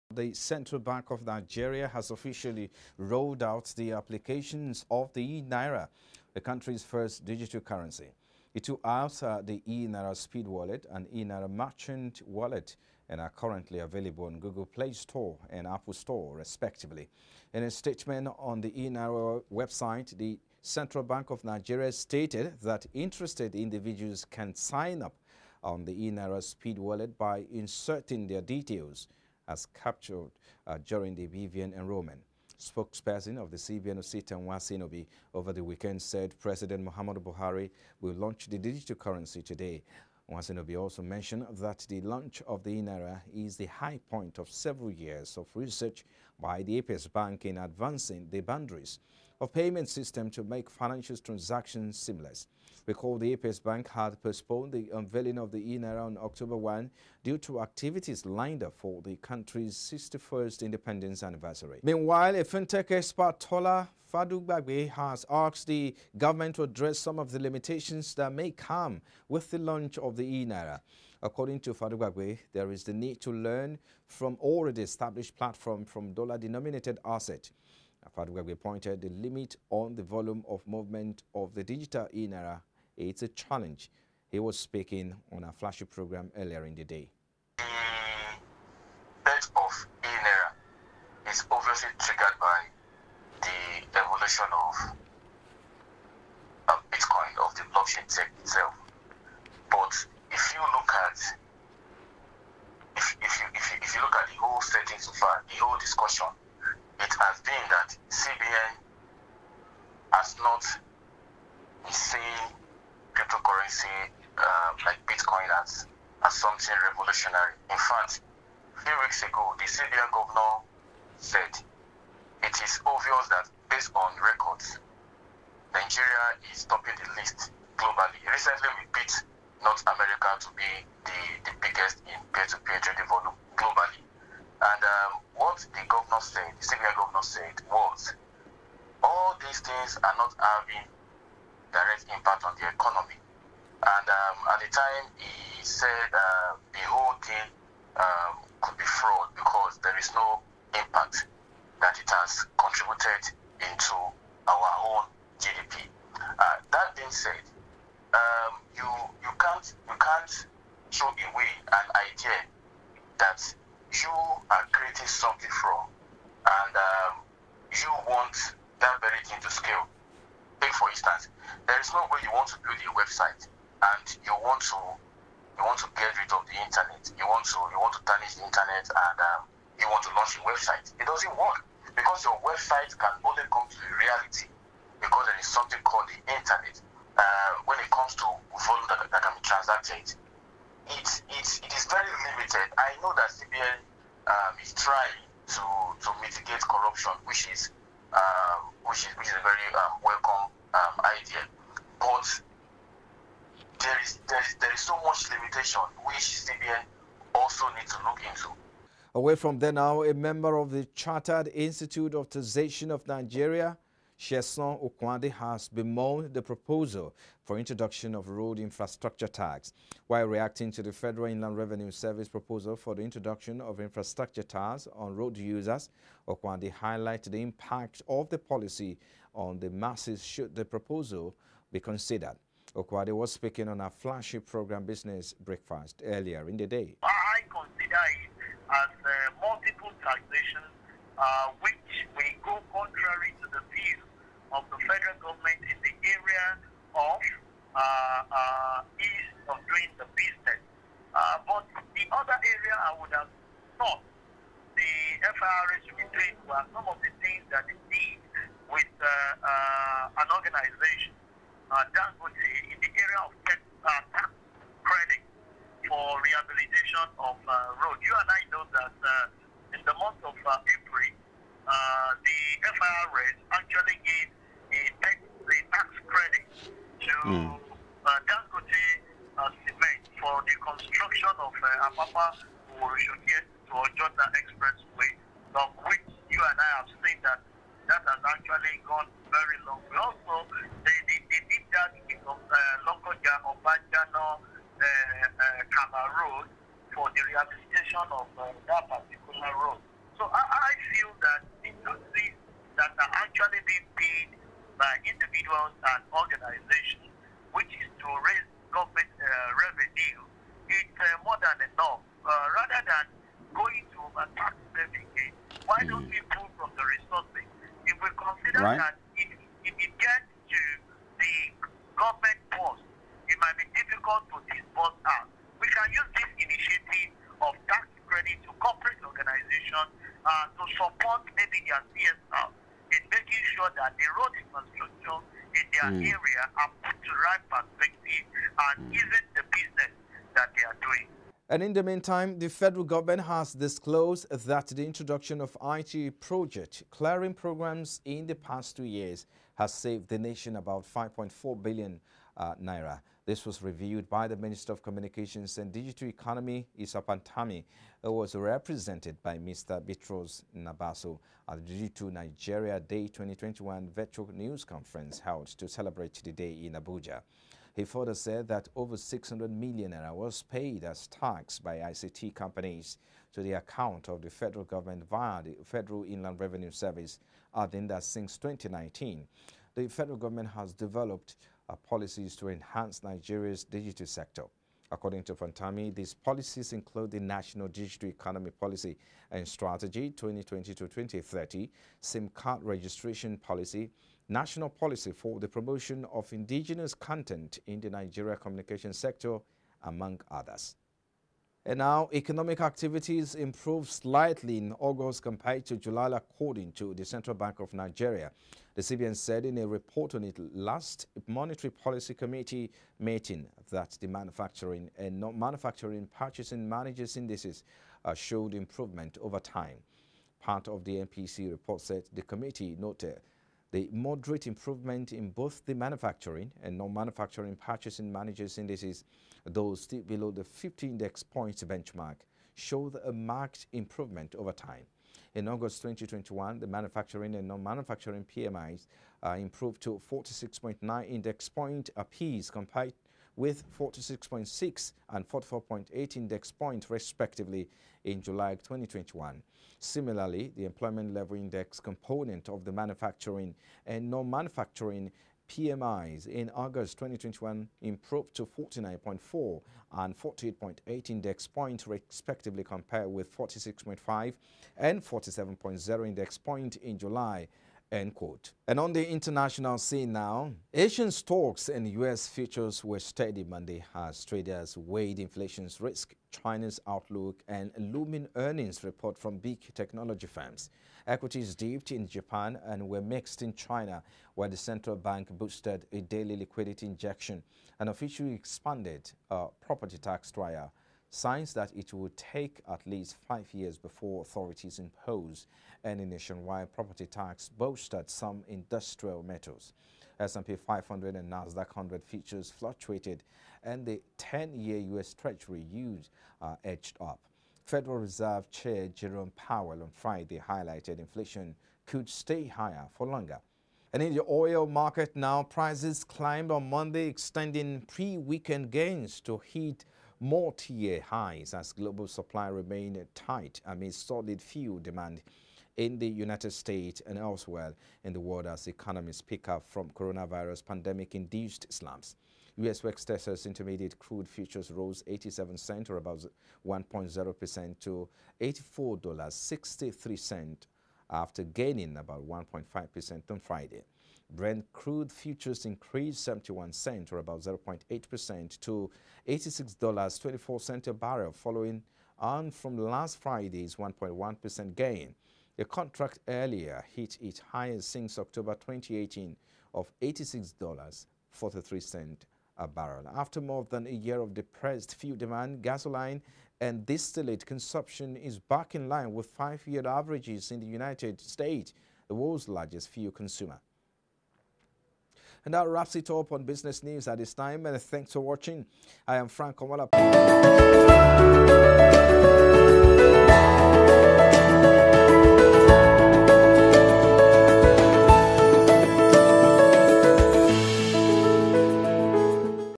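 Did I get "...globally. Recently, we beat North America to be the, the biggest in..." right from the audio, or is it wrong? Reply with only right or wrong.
right.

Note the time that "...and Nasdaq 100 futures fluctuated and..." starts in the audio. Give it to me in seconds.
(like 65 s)
501 s.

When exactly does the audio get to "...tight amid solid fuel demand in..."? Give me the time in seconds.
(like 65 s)
523 s.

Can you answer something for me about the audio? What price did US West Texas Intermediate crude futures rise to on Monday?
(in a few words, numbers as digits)
$84.63.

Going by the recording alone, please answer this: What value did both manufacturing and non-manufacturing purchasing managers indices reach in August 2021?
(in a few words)
46.9.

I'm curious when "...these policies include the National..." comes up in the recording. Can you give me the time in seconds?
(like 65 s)
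385 s.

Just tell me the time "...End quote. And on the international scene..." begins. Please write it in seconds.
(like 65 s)
467 s.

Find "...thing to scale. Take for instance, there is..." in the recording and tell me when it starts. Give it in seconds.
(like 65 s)
169 s.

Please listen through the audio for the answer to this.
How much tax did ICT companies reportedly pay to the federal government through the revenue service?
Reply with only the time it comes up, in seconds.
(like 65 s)
368 s.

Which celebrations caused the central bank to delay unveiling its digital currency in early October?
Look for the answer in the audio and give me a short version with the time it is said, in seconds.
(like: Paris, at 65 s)
61st independence anniversary, at 59 s.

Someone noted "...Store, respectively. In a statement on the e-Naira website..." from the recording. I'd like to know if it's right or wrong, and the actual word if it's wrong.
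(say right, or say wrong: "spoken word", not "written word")
right.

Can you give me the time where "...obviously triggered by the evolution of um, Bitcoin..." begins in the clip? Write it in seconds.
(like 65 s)
91 s.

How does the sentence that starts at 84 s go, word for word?
He was speaking on a flashy program earlier in the day.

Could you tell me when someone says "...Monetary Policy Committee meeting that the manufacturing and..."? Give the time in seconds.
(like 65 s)
411 s.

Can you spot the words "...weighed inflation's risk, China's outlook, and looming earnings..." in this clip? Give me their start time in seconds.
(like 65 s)
474 s.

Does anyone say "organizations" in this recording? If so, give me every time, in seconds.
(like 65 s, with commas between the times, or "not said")
306 s, 329 s.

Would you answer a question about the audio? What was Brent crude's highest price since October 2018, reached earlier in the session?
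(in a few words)
$86.43 a barrel.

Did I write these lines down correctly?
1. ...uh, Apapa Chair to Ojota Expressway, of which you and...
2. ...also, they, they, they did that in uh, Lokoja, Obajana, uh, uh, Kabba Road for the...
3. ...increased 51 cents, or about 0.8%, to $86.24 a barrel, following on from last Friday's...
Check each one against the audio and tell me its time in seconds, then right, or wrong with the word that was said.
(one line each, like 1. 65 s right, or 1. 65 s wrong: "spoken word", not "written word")
1. 281 s wrong: "Oworonshoki", not "Chair"
2. 289 s right
3. 545 s wrong: "71", not "51".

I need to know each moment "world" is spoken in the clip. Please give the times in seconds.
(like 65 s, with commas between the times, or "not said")
528 s, 572 s.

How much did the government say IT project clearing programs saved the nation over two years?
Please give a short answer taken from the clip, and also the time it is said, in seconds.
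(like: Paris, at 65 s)
5.4 billion naira, at 350 s.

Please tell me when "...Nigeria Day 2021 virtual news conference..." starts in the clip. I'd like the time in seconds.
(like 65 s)
362 s.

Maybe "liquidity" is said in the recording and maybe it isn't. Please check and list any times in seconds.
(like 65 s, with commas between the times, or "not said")
486 s.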